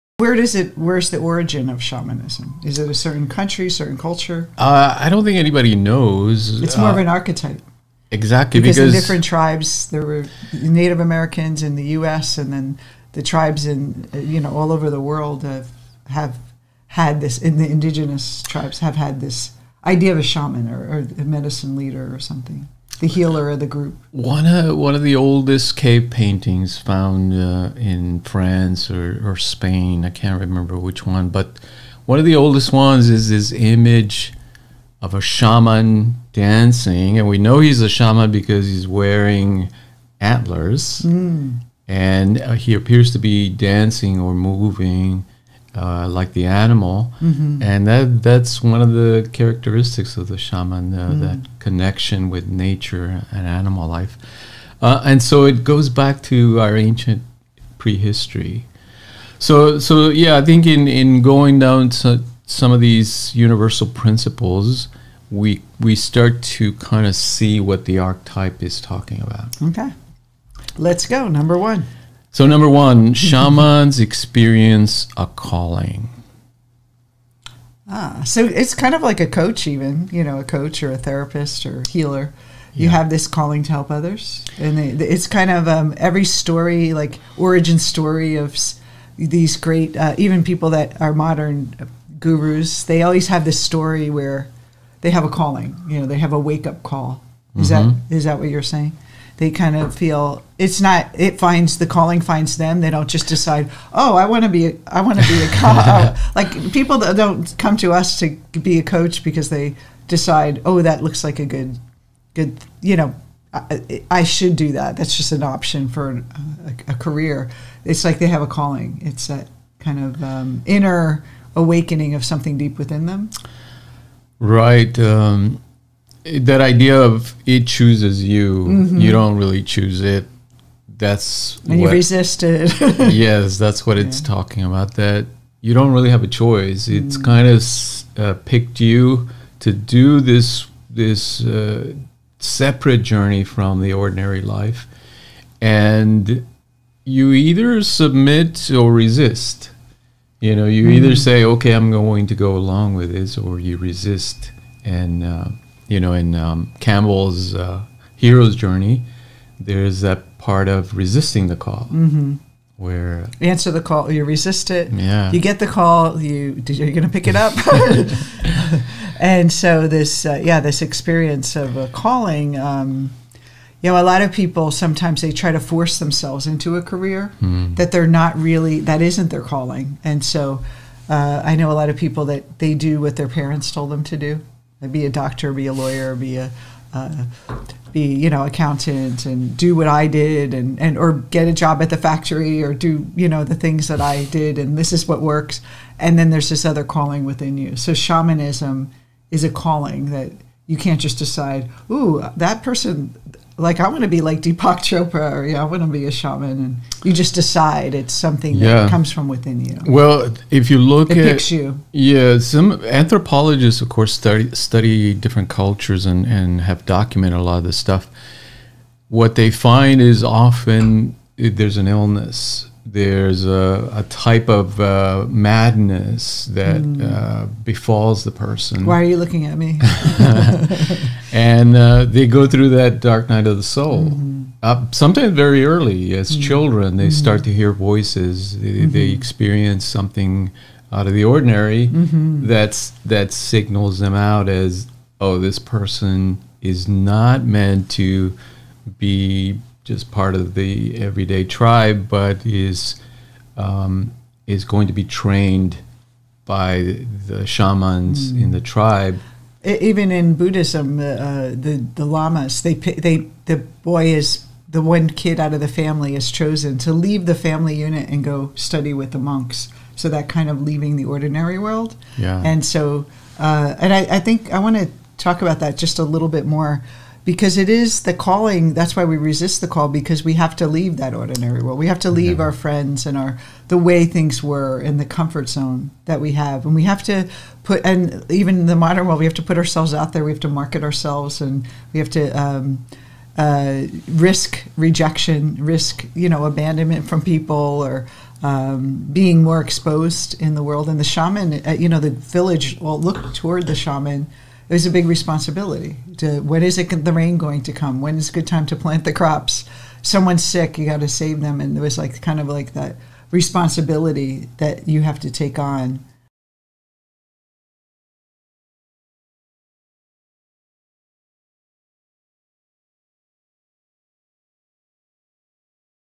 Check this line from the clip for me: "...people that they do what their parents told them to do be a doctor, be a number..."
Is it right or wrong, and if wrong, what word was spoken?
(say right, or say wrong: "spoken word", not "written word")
wrong: "lawyer", not "number".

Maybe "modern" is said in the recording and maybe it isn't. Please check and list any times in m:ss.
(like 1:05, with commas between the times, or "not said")
1:31, 4:48.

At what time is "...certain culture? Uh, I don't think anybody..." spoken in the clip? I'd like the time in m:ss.
0:03.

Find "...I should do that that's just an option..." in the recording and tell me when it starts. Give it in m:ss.
1:54.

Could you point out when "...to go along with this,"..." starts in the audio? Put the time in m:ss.
2:32.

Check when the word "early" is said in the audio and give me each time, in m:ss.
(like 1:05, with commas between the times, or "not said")
3:55.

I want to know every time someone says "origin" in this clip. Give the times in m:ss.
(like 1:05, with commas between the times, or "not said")
0:01, 1:27.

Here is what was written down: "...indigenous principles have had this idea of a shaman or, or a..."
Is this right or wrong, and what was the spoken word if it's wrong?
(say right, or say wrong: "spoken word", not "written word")
wrong: "tribes", not "principles".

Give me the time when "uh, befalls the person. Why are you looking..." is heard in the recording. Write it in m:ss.
3:47.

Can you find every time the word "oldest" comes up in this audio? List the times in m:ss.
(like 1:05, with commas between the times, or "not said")
0:25, 0:32.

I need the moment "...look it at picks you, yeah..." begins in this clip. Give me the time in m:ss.
3:30.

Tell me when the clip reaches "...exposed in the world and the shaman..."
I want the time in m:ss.
4:59.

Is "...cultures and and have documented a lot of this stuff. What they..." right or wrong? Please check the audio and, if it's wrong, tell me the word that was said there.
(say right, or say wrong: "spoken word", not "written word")
right.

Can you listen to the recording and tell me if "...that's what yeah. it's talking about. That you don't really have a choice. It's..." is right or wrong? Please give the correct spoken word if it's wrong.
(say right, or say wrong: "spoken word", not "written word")
right.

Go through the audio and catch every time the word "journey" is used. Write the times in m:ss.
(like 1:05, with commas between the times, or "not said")
2:23, 2:38.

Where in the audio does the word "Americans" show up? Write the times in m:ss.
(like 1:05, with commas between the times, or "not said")
0:10.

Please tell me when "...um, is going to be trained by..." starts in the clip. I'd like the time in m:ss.
4:13.